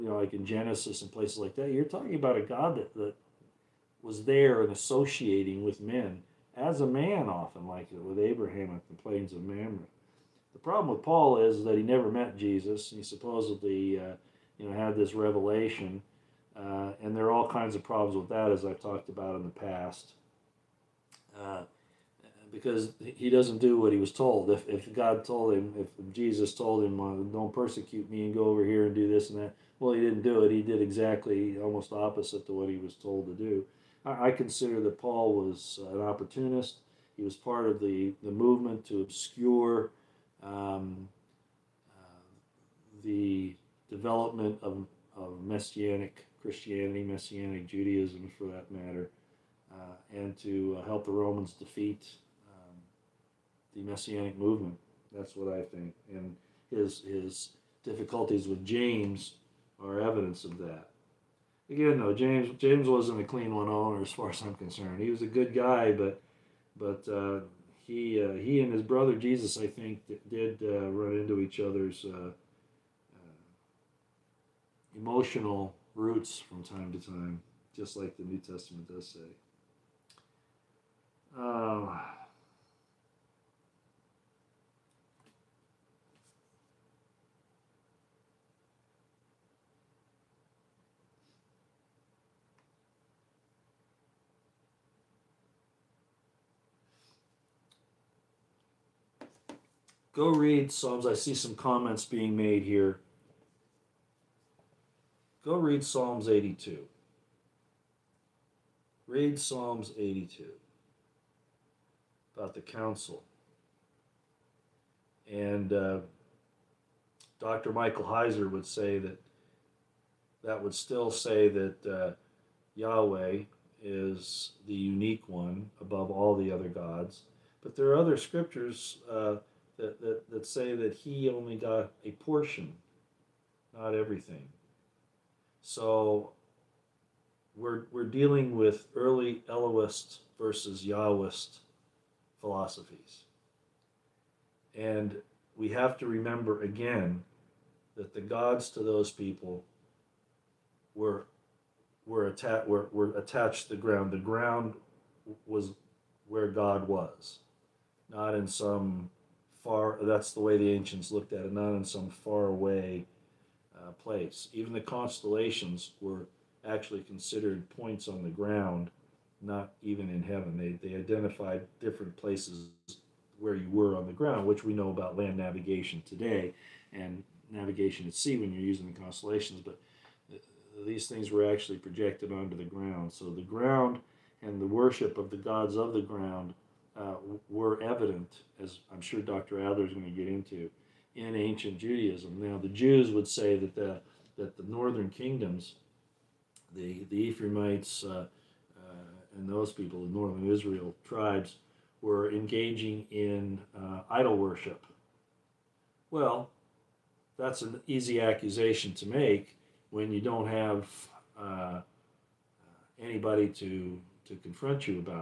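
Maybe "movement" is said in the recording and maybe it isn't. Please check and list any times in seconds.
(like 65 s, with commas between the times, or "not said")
38 s, 54 s.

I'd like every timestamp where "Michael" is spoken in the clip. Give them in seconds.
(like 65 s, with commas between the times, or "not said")
117 s.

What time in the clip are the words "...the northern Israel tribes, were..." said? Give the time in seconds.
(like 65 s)
200 s.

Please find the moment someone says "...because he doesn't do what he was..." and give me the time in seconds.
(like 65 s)
22 s.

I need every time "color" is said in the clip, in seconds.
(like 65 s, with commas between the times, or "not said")
not said.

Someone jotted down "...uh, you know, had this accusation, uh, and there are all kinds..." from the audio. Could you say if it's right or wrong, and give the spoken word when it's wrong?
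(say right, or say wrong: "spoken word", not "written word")
wrong: "revelation", not "accusation".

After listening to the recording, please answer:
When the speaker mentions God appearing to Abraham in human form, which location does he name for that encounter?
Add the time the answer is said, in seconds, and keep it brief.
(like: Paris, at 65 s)
plains of Mamre, at 9 s.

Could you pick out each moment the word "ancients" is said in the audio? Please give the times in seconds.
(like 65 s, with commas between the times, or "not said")
160 s, 191 s.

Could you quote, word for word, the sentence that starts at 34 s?
I, I consider that Paul was an opportunist.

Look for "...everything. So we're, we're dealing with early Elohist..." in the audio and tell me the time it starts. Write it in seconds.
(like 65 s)
133 s.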